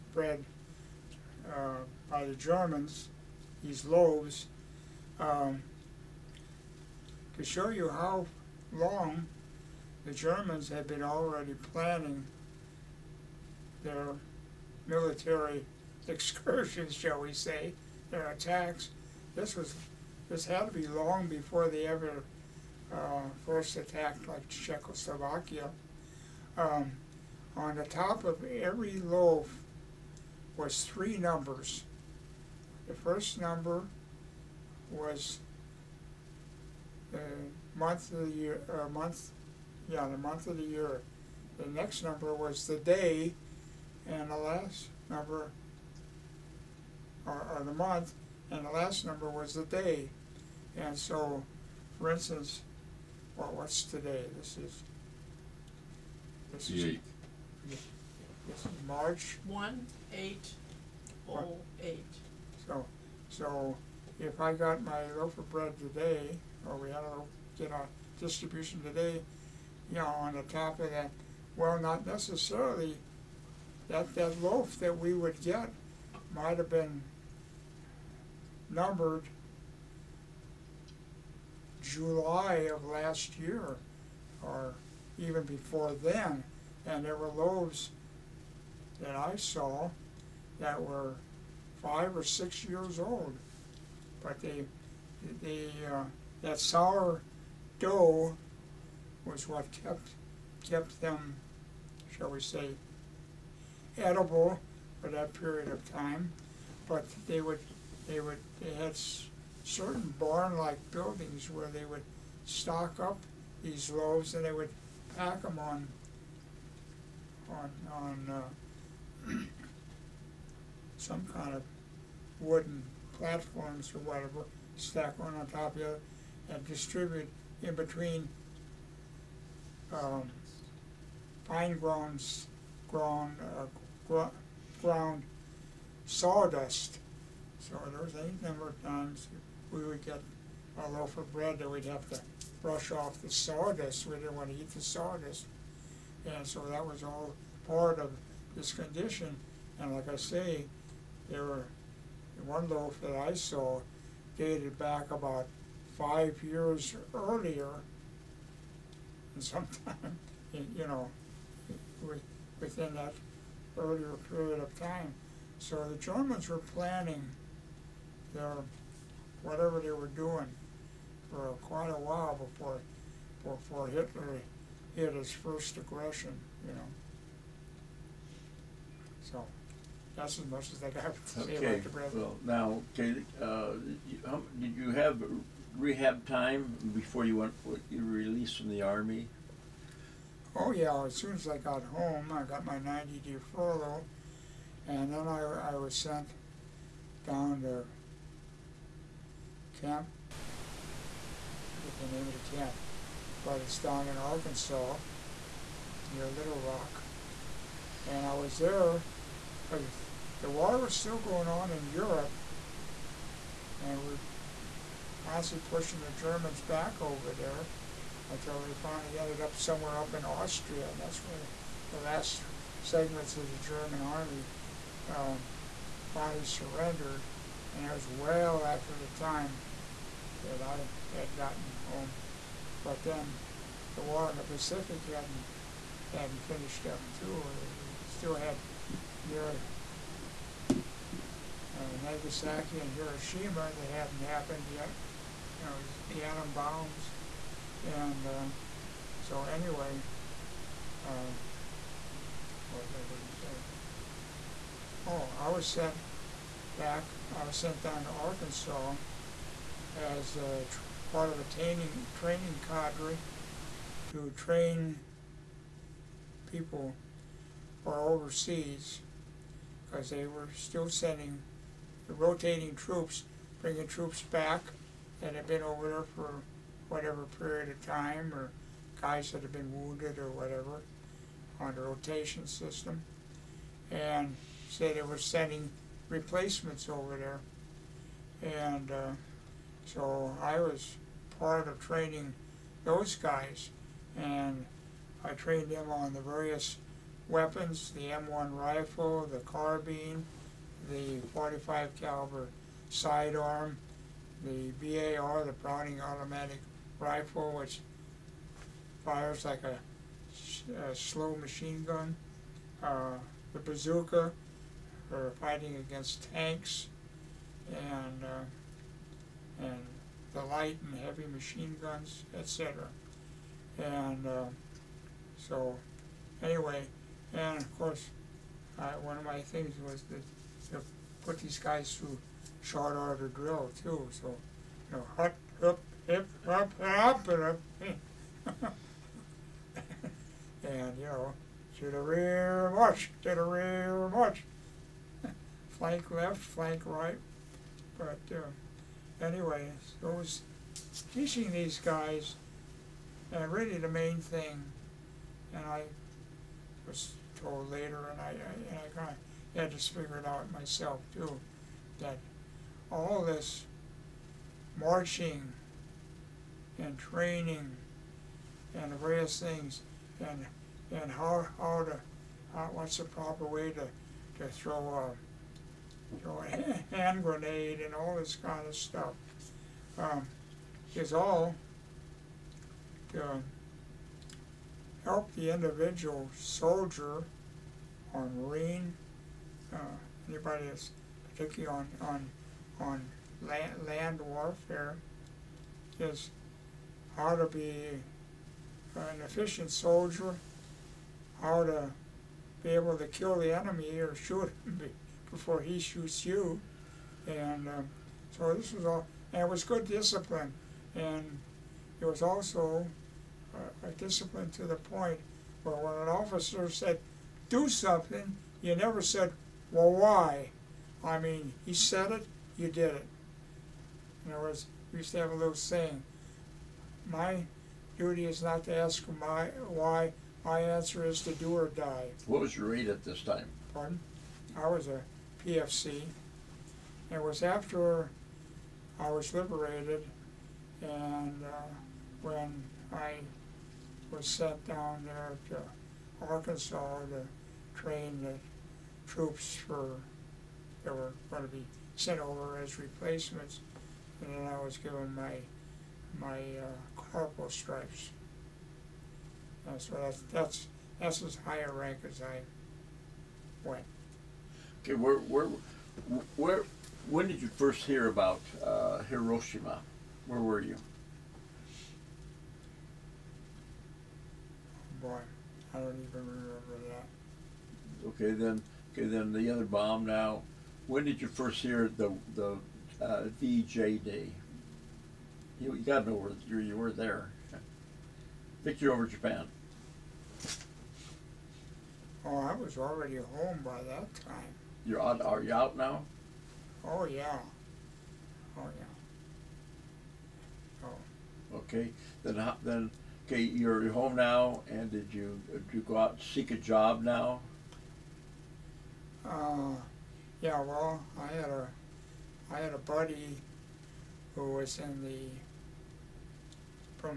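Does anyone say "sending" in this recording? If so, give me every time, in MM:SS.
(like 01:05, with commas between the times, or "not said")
04:30, 04:45.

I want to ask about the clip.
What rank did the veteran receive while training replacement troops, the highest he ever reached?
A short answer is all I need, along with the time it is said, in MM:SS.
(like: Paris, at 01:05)
Corporal, at 07:37.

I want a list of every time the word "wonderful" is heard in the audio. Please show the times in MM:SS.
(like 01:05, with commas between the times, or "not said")
not said.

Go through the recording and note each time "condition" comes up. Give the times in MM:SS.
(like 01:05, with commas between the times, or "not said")
02:28.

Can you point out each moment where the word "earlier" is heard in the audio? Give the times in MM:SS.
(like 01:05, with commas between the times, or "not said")
02:37, 02:43.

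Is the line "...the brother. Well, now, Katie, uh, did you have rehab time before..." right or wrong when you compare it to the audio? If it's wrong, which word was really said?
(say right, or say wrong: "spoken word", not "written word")
right.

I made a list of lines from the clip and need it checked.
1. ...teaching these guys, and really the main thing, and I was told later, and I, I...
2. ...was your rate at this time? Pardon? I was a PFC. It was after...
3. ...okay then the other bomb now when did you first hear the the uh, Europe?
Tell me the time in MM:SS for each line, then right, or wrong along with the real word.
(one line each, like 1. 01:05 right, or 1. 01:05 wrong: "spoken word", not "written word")
1. 05:51 right
2. 07:12 right
3. 07:58 wrong: "VJD", not "Europe".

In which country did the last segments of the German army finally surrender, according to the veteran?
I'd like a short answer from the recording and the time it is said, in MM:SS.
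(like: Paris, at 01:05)
Austria, at 03:40.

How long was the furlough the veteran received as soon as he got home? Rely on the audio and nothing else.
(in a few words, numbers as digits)
90 days.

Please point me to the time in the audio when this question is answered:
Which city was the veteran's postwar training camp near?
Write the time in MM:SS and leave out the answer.
03:26.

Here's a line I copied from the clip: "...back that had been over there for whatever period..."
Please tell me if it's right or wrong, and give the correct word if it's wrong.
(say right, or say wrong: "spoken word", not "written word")
right.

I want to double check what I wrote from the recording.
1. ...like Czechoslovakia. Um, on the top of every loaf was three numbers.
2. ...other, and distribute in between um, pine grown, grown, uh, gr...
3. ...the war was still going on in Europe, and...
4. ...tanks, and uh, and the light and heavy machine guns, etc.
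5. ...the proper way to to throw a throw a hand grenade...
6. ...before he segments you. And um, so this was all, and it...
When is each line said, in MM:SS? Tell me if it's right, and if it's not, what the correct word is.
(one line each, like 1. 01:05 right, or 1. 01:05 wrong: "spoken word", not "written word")
1. 00:24 right
2. 02:05 right
3. 03:30 right
4. 05:16 right
5. 06:12 right
6. 06:45 wrong: "shoots", not "segments".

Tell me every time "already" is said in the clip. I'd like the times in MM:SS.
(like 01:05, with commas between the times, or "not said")
00:11, 08:12.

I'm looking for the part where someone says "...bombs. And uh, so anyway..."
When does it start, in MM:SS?
04:06.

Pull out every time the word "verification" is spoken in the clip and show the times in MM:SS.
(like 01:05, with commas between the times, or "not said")
not said.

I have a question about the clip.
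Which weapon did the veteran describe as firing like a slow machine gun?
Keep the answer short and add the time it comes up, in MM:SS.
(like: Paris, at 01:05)
Browning Automatic Rifle, at 05:05.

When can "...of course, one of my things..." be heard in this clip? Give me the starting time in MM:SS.
05:27.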